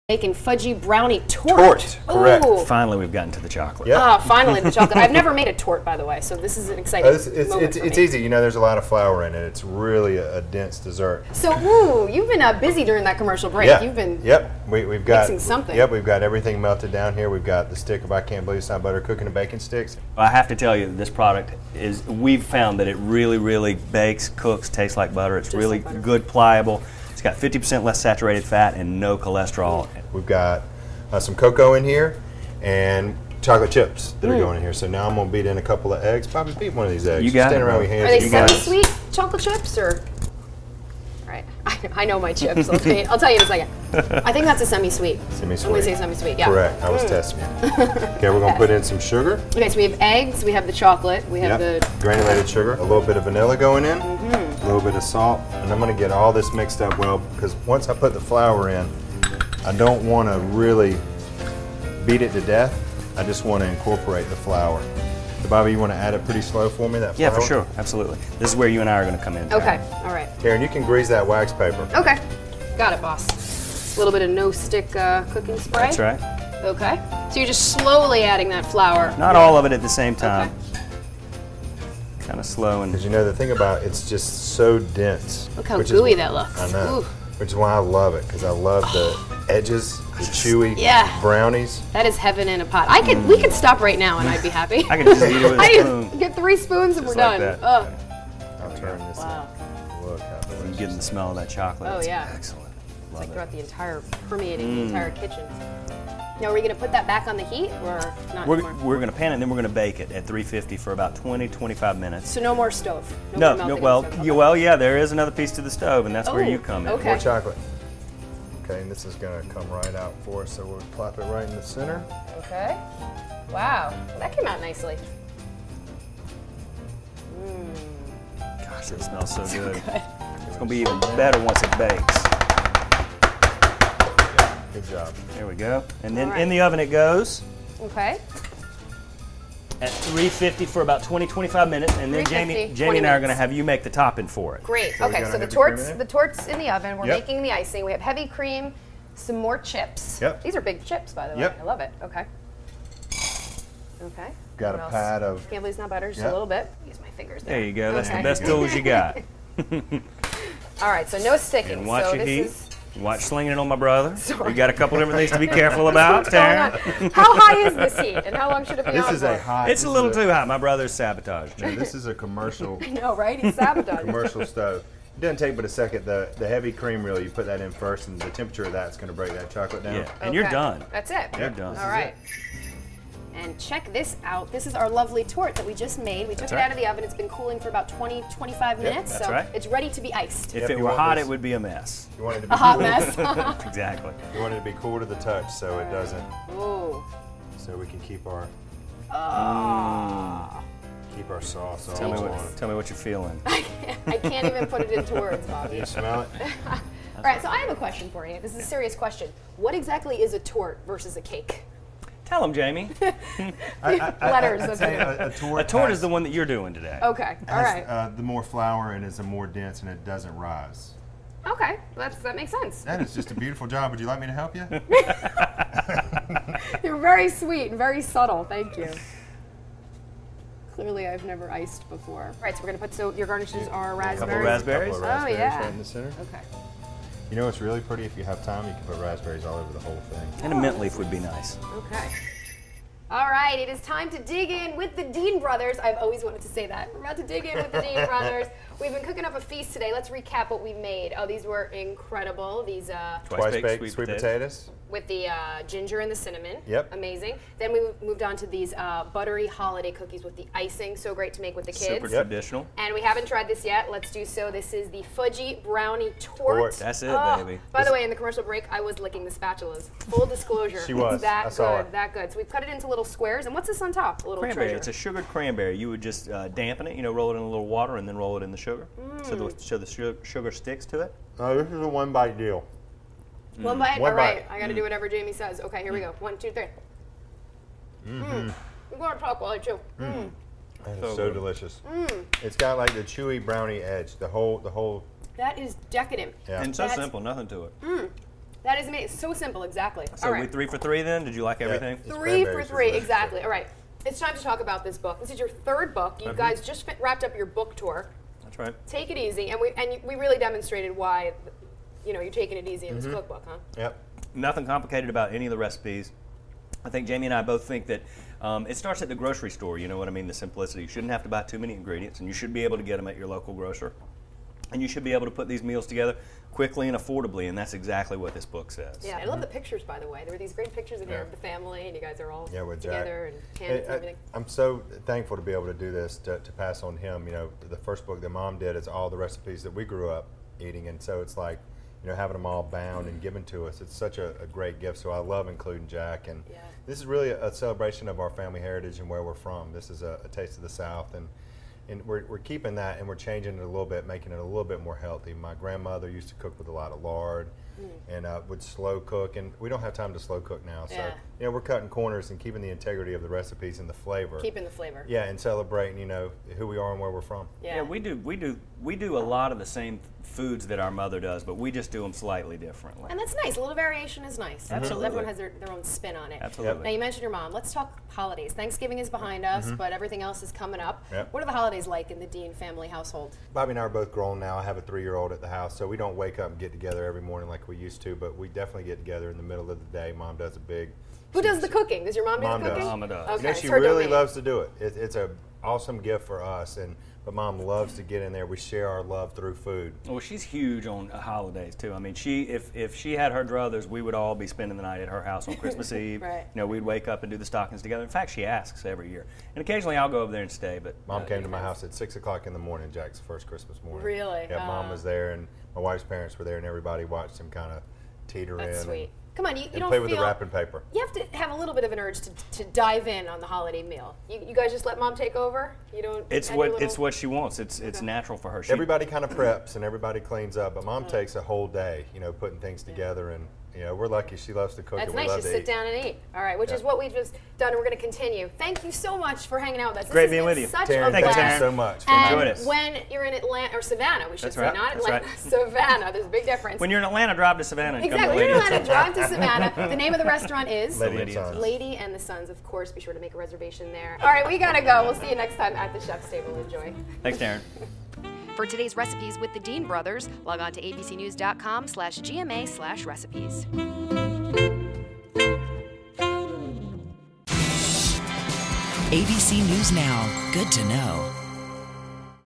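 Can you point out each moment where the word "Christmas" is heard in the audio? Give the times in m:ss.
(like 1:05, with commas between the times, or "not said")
6:45, 6:53.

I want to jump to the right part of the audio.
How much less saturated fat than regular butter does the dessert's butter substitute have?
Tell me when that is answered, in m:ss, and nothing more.
0:27.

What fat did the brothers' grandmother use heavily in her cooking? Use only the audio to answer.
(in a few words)
Lard.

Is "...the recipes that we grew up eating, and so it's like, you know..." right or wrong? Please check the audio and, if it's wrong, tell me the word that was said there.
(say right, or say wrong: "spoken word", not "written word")
right.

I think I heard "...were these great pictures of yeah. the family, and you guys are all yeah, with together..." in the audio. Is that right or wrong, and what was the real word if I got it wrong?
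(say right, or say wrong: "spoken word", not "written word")
right.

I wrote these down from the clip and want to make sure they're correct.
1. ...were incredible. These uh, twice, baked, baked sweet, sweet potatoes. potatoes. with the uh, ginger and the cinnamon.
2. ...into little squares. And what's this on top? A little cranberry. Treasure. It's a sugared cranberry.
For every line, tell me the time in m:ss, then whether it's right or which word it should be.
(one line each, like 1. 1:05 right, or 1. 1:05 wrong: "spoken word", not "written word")
1. 4:11 right
2. 4:32 right.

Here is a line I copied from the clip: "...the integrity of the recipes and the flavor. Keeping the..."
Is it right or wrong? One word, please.
right.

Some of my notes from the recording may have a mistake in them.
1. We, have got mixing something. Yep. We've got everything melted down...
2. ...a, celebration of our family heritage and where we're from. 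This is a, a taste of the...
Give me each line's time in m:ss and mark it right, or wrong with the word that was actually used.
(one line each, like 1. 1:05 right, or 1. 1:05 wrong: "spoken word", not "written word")
1. 0:14 right
2. 5:47 right.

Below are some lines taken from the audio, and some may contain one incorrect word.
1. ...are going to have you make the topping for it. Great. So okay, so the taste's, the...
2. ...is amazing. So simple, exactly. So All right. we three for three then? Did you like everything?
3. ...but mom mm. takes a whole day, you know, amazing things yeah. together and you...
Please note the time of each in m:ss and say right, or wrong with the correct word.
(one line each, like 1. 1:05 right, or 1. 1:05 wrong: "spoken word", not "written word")
1. 2:23 wrong: "torte", not "taste"
2. 4:58 right
3. 7:10 wrong: "putting", not "amazing".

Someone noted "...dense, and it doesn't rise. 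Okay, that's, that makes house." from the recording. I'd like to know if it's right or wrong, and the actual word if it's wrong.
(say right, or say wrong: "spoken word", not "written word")
wrong: "sense", not "house".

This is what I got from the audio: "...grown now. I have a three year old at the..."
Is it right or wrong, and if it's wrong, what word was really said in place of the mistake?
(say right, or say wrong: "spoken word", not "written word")
right.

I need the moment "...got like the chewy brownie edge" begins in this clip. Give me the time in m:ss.
4:52.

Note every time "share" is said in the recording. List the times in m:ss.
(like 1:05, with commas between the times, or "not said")
6:38.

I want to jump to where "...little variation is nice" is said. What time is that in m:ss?
6:13.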